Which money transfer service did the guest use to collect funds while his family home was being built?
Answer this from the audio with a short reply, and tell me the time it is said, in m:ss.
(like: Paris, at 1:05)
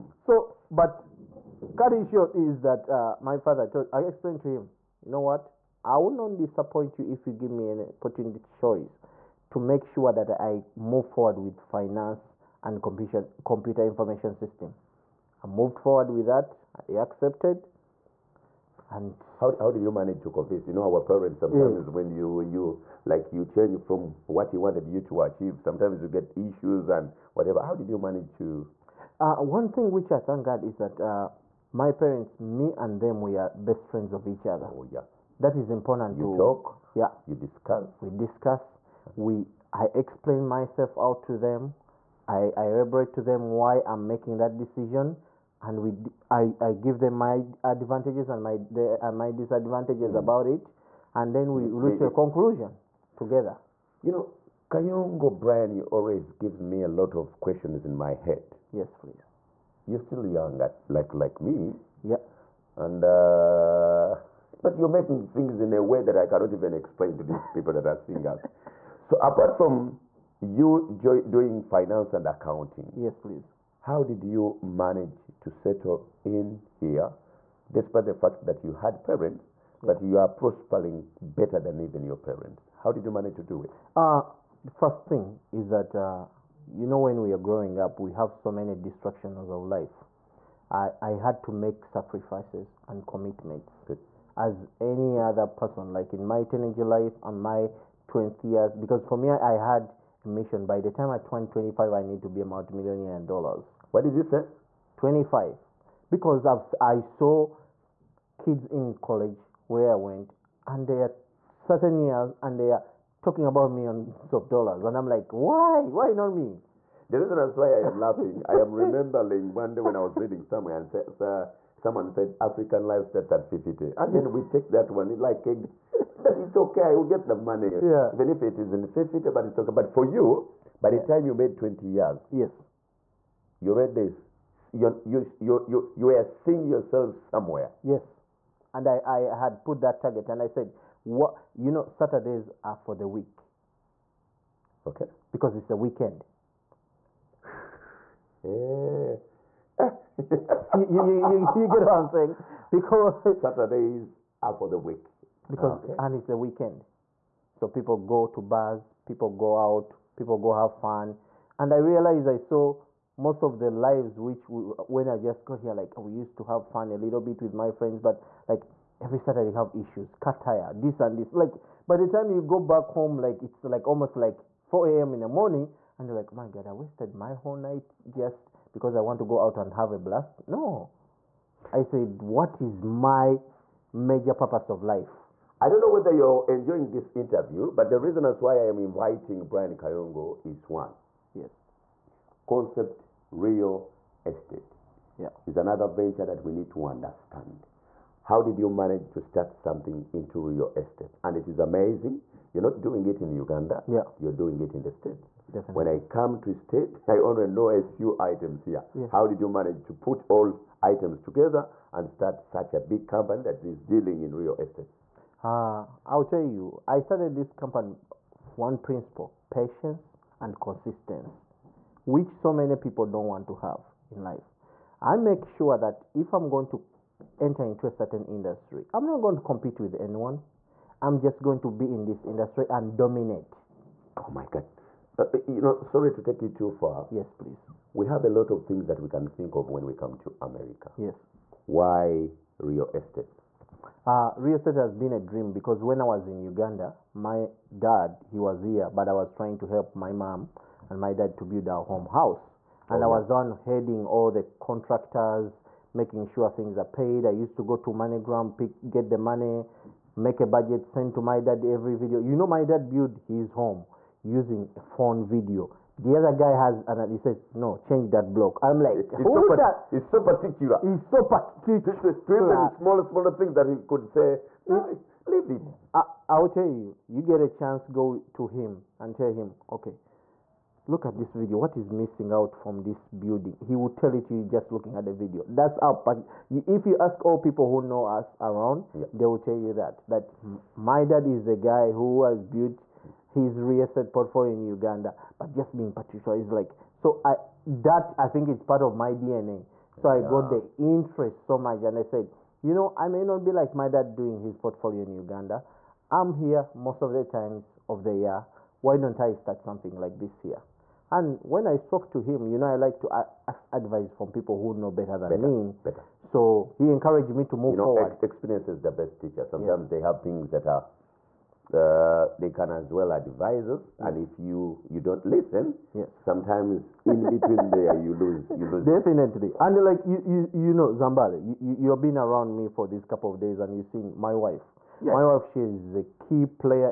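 MoneyGram, at 4:17.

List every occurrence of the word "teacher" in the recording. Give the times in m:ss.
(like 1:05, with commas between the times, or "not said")
5:19.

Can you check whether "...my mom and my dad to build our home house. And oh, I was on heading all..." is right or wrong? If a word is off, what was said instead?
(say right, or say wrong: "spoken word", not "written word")
right.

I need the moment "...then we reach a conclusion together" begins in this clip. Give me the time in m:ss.
0:51.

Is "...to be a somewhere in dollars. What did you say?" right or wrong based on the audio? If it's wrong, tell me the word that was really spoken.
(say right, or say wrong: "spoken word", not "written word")
wrong: "multimillionaire", not "somewhere".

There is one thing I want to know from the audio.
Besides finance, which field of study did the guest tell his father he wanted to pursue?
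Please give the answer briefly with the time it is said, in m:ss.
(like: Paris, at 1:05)
Computer Information System, at 0:12.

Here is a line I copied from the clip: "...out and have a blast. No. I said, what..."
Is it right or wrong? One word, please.
right.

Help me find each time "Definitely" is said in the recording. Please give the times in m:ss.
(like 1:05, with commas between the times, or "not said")
3:25, 5:28.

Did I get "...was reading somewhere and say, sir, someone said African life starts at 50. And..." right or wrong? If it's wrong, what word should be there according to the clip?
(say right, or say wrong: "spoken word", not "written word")
right.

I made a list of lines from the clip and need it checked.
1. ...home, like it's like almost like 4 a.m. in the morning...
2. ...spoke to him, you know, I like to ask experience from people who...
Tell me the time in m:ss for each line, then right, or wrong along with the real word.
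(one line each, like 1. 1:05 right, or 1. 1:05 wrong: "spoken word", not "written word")
1. 2:52 right
2. 5:11 wrong: "advice", not "experience".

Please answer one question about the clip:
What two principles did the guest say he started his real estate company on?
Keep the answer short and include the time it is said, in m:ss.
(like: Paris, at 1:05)
Patience and consistency, at 3:39.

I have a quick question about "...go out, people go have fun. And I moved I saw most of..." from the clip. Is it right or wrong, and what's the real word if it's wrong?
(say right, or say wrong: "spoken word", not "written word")
wrong: "realized", not "moved".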